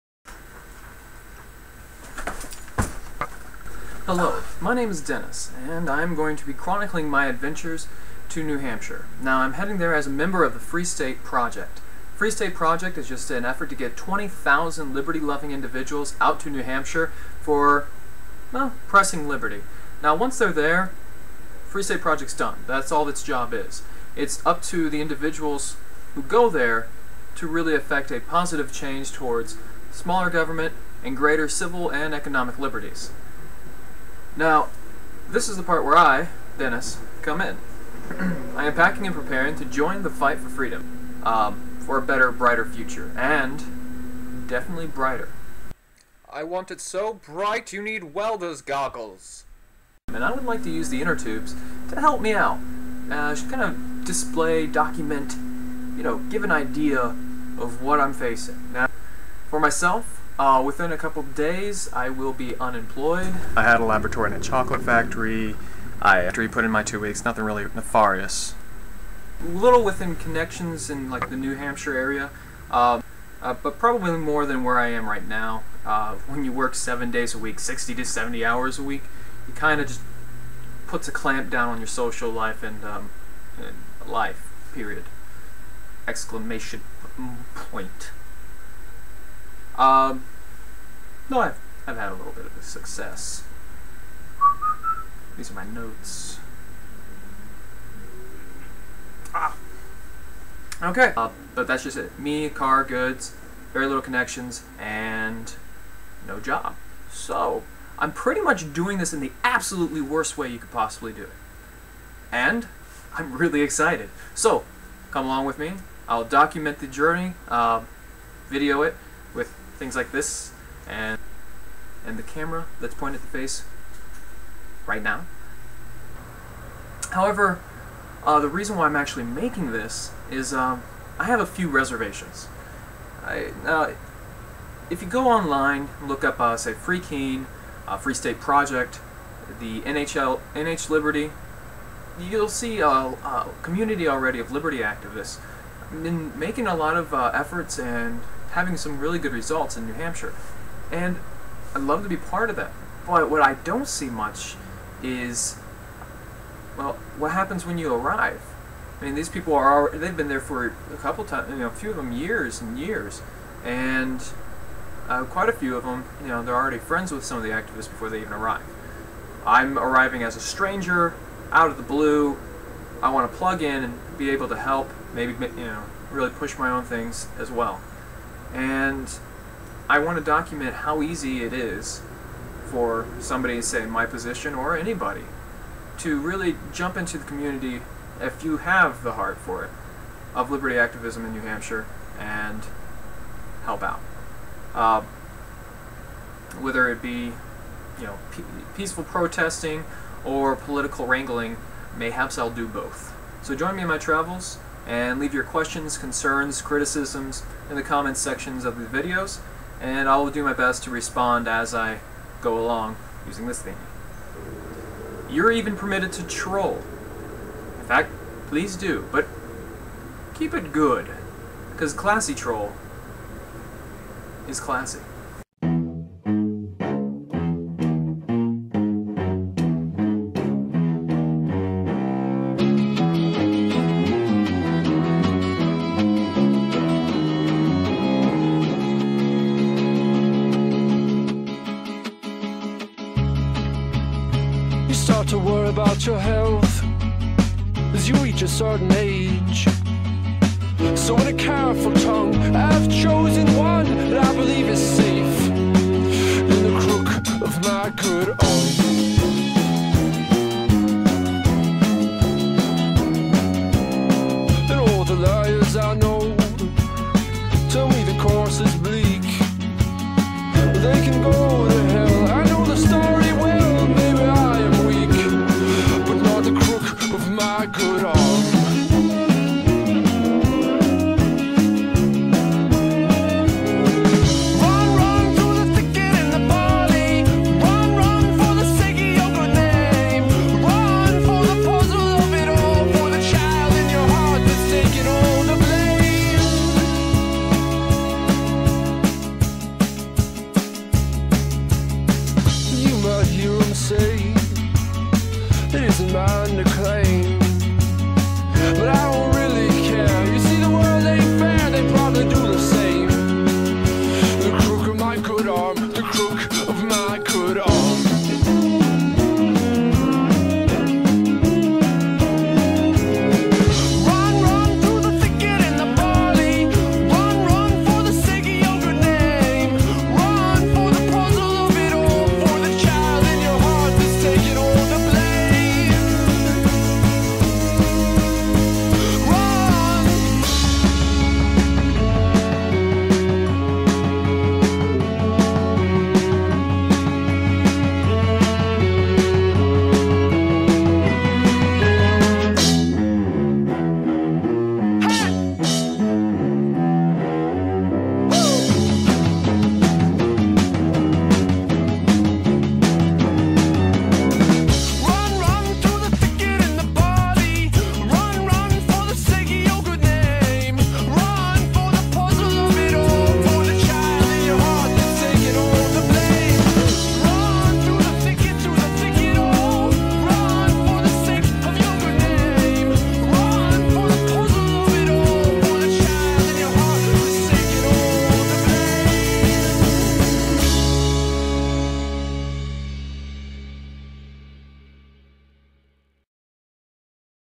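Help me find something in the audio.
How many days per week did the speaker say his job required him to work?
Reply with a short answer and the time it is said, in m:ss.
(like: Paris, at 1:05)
7, at 1:16.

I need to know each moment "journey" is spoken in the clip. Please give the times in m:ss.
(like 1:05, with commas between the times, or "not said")
1:56.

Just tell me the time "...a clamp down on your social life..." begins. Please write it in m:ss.
1:21.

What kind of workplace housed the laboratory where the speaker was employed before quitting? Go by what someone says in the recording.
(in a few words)
chocolate factory.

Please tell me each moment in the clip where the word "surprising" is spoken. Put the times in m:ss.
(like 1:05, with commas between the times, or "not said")
not said.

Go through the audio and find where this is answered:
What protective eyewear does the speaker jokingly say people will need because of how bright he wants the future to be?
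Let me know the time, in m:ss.
0:48.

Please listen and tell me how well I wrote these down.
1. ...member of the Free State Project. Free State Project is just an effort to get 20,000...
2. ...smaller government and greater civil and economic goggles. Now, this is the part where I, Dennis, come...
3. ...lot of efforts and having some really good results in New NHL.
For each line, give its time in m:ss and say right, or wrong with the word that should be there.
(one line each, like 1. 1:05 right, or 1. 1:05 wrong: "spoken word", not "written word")
1. 0:10 right
2. 0:29 wrong: "liberties", not "goggles"
3. 2:26 wrong: "Hampshire", not "NHL".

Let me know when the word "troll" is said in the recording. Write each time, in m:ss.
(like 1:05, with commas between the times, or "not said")
3:36, 3:42.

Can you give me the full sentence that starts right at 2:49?
I'm arriving as a stranger, out of the blue.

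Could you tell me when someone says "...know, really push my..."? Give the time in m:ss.
2:55.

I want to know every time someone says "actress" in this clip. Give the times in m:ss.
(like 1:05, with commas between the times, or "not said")
not said.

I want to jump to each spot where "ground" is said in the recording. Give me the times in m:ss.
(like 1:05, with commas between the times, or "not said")
not said.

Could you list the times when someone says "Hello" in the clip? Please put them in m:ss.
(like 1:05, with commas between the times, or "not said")
0:04.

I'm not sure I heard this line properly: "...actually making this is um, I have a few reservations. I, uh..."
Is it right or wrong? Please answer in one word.
right.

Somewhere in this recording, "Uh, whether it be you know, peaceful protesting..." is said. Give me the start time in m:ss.
3:14.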